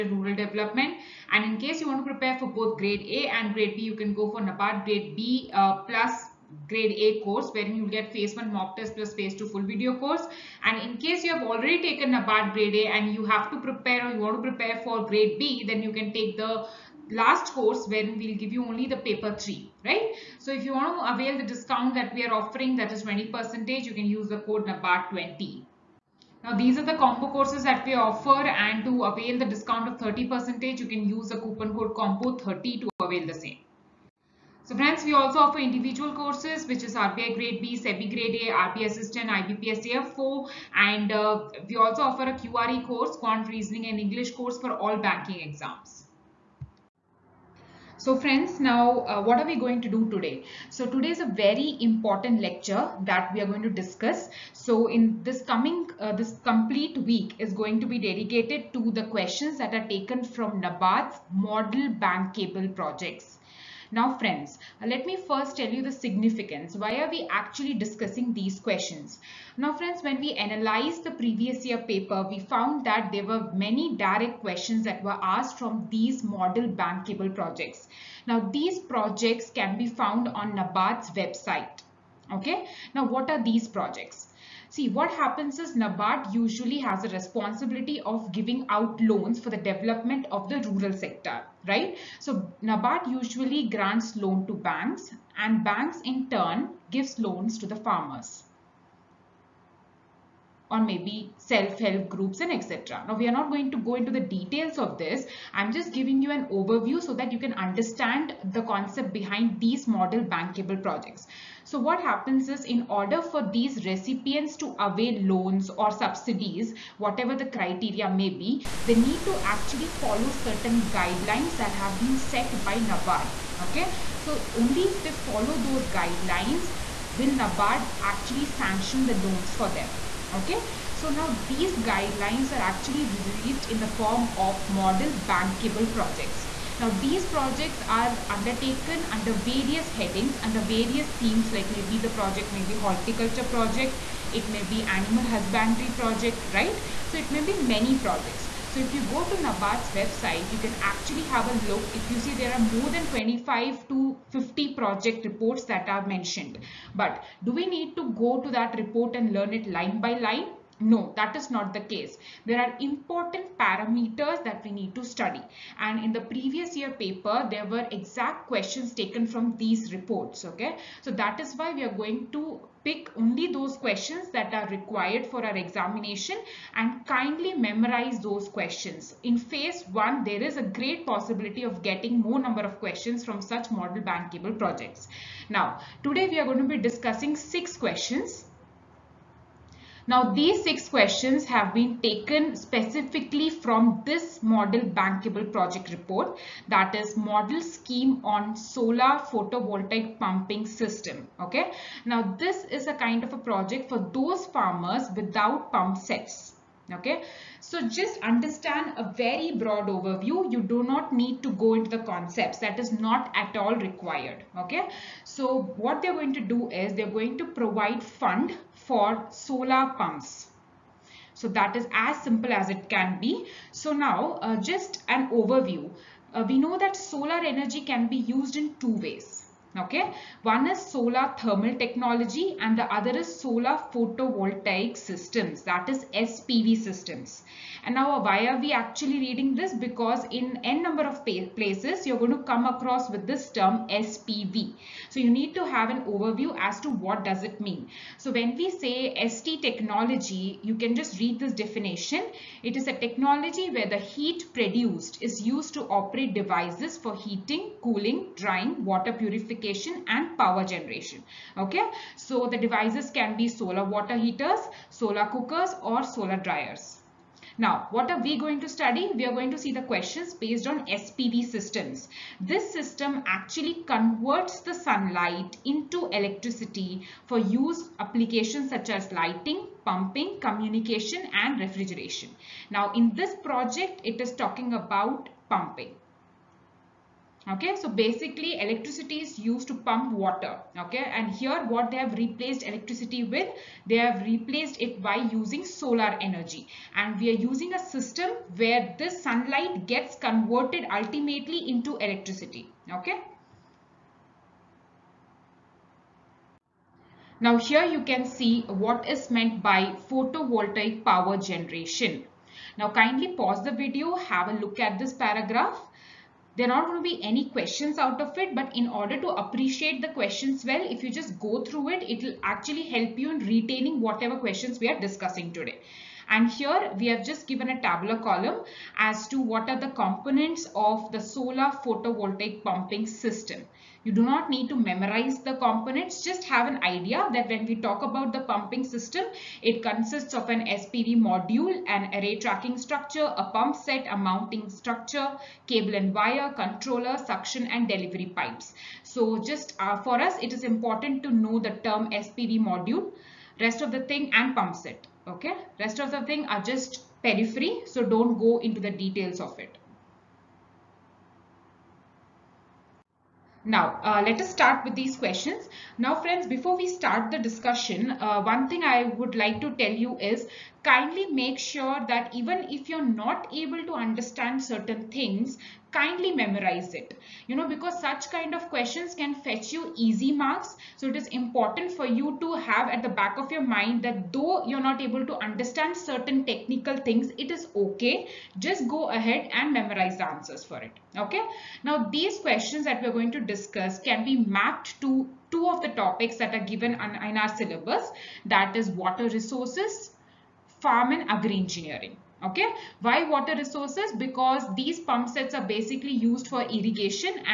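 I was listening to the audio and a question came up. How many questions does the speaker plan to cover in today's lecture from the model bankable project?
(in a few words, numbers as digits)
6.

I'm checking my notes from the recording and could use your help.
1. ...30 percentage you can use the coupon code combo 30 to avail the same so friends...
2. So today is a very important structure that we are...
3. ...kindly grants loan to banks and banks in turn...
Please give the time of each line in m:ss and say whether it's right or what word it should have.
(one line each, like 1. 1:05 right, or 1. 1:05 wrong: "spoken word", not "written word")
1. 0:29 right
2. 0:50 wrong: "lecture", not "structure"
3. 1:33 wrong: "usually", not "kindly".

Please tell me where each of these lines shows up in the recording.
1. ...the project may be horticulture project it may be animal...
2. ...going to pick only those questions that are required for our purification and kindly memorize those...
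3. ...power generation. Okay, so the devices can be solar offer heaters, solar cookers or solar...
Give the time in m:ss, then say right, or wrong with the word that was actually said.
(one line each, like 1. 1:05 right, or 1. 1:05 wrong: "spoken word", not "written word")
1. 2:21 right
2. 2:51 wrong: "examination", not "purification"
3. 4:20 wrong: "water", not "offer".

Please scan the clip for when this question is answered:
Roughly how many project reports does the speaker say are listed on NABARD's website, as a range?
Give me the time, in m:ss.
2:33.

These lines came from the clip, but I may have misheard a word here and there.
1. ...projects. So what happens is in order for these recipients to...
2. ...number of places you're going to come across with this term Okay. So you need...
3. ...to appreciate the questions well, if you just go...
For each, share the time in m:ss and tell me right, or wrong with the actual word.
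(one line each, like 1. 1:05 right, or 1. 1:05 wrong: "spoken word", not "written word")
1. 1:50 right
2. 4:00 wrong: "SPV", not "Okay"
3. 5:19 right.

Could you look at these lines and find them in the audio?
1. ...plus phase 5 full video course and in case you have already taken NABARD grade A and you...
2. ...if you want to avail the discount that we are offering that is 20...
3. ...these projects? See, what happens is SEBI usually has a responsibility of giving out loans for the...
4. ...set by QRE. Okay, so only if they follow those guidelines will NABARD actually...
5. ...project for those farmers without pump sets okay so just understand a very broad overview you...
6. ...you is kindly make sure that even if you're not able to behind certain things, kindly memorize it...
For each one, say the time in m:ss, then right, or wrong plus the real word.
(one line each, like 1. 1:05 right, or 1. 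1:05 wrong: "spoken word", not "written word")
1. 0:08 wrong: "2", not "5"
2. 0:20 right
3. 1:23 wrong: "NABARD", not "SEBI"
4. 2:02 wrong: "NABARD", not "QRE"
5. 3:23 right
6. 6:09 wrong: "understand", not "behind".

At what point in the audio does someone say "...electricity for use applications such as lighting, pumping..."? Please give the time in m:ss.
4:36.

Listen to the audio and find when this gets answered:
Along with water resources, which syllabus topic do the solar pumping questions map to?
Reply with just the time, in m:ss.
6:40.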